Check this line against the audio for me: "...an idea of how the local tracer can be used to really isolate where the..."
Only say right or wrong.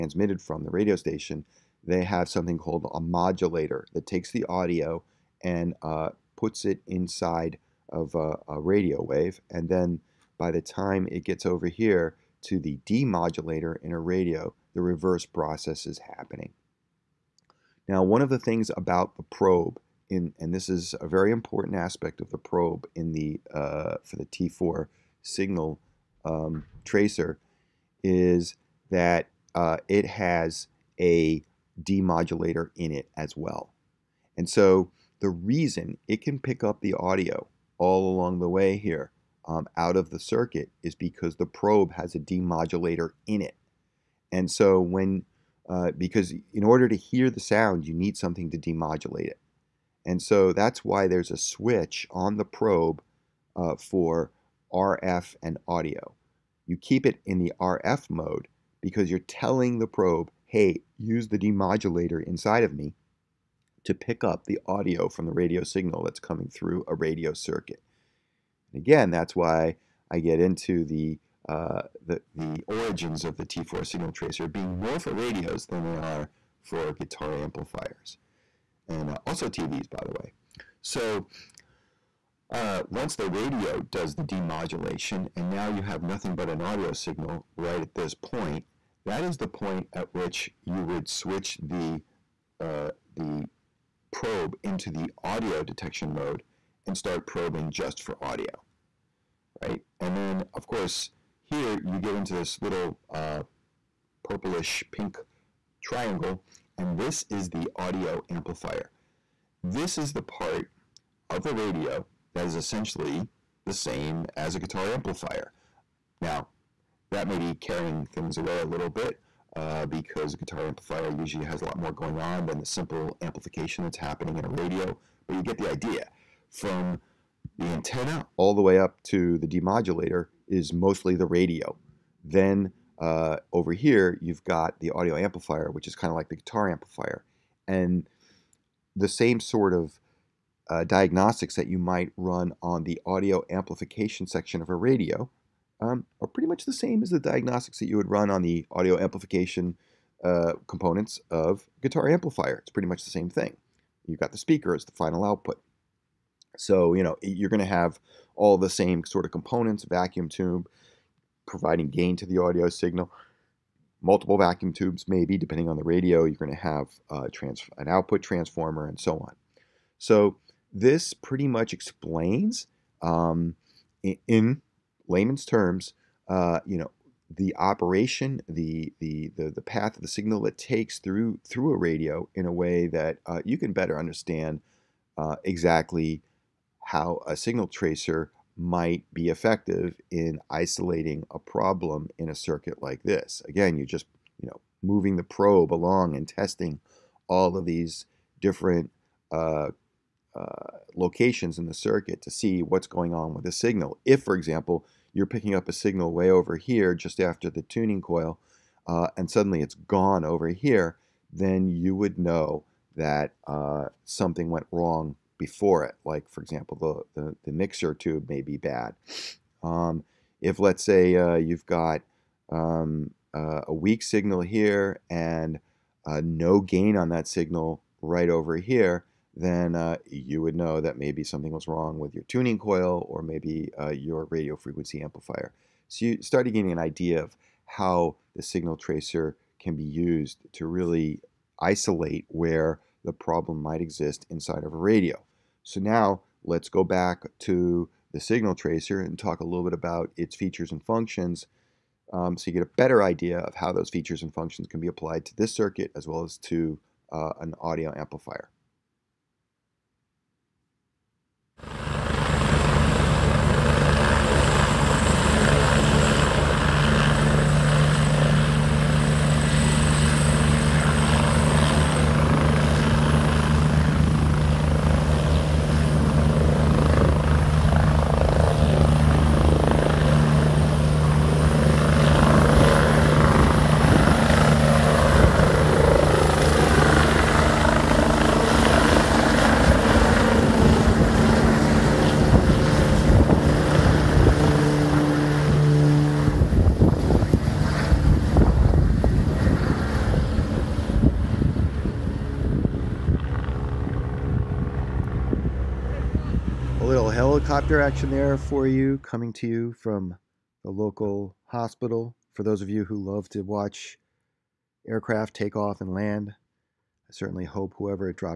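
wrong.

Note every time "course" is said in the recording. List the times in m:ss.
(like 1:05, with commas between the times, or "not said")
1:40.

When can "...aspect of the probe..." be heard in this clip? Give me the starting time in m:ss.
0:21.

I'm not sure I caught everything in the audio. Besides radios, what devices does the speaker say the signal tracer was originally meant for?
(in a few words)
TVs.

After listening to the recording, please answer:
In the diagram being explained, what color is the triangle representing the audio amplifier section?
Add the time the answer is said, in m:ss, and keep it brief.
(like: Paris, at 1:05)
purplish pink, at 1:44.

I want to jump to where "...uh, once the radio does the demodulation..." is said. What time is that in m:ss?
1:22.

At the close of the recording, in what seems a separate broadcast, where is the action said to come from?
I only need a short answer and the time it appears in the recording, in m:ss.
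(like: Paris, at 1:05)
local hospital, at 5:10.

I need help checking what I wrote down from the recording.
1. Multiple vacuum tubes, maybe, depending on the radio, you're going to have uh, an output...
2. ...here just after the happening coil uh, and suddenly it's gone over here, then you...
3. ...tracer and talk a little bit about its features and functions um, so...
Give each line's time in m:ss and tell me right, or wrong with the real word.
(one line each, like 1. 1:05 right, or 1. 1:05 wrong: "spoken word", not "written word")
1. 2:44 right
2. 3:26 wrong: "tuning", not "happening"
3. 4:08 right.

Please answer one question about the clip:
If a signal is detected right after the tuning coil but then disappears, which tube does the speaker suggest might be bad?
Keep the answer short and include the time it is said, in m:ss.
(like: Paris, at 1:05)
mixer tube, at 3:37.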